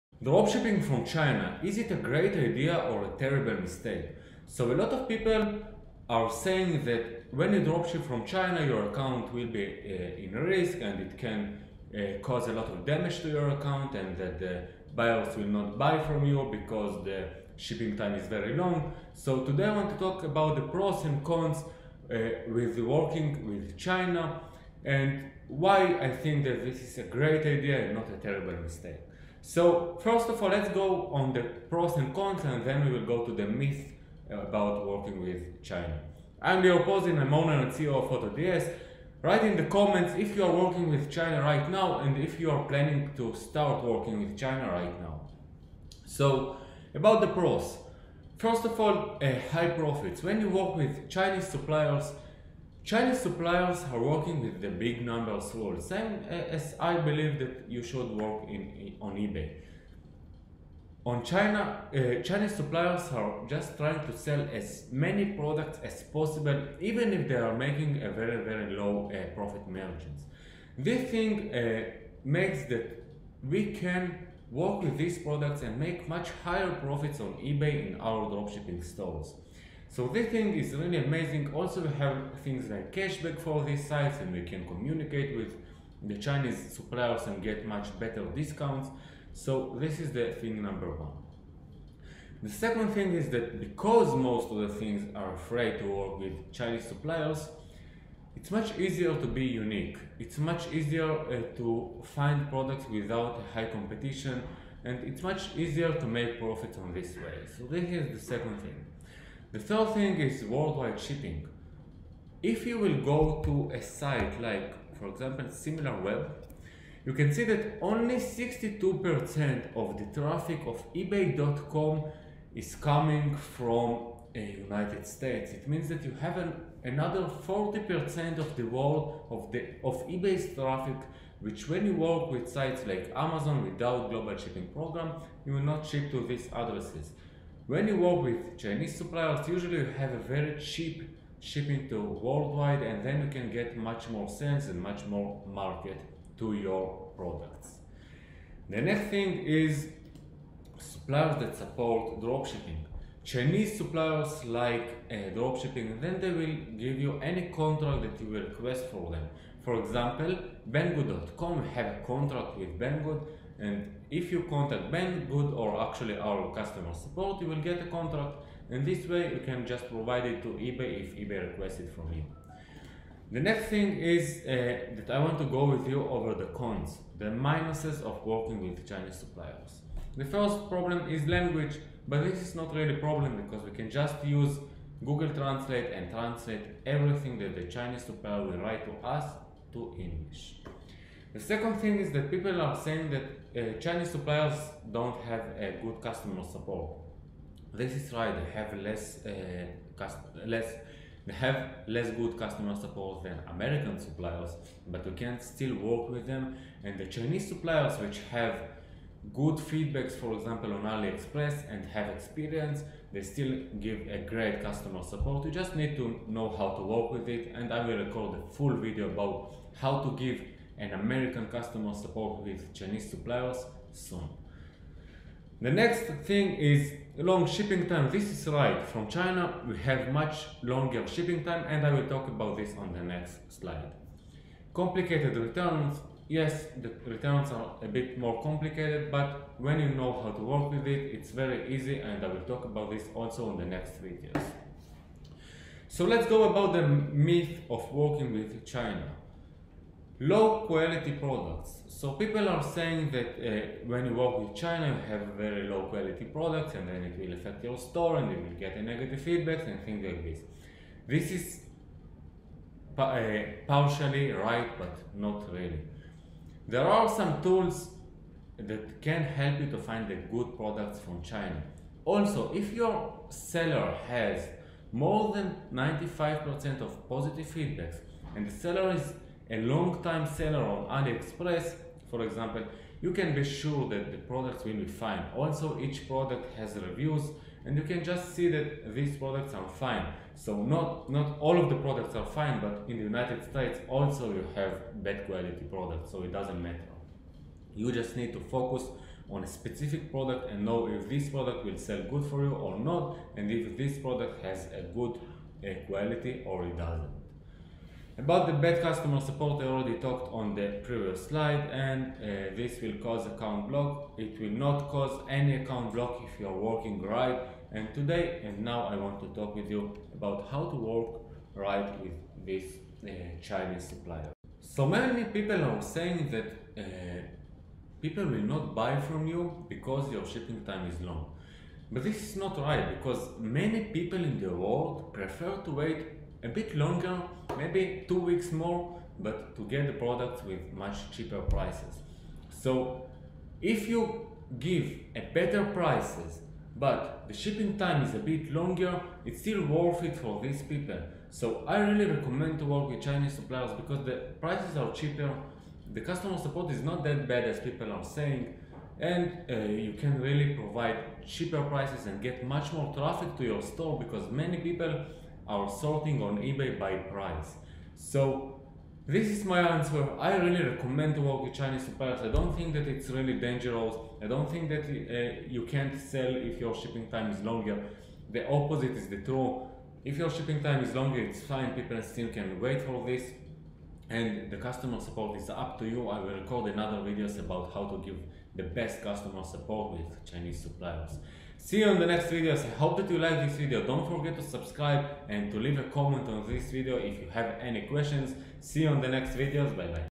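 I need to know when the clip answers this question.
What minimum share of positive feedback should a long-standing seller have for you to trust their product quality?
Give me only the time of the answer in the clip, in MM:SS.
04:35.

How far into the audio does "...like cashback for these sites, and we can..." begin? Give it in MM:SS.
01:22.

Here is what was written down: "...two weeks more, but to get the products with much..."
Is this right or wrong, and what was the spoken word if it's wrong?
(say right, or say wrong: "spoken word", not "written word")
right.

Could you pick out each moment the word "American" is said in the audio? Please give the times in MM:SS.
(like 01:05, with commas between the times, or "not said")
03:23, 03:40.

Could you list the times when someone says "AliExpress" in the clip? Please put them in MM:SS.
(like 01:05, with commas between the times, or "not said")
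03:30, 04:41.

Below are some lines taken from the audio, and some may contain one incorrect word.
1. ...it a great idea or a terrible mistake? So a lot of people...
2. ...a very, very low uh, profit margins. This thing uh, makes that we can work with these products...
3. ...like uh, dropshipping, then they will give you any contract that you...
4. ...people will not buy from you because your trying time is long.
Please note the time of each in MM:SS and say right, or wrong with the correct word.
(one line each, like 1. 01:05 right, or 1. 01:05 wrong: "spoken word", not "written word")
1. 00:01 right
2. 01:08 right
3. 02:34 right
4. 05:28 wrong: "shipping", not "trying".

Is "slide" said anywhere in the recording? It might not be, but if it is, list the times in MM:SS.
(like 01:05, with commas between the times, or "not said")
03:53, 05:11.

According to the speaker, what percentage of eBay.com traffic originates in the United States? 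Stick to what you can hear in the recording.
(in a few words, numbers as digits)
62%.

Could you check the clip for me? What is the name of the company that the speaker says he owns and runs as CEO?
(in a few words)
AutoDS.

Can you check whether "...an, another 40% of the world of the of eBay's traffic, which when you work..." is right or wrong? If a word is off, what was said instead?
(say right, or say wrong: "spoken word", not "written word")
right.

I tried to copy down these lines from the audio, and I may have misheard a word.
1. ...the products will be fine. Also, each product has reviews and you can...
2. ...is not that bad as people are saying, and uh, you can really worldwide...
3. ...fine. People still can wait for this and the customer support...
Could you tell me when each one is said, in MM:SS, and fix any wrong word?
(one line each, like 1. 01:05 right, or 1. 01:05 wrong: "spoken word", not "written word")
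1. 04:44 right
2. 05:56 wrong: "provide", not "worldwide"
3. 06:21 right.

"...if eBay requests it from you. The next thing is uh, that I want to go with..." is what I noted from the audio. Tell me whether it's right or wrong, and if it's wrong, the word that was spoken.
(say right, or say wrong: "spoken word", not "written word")
right.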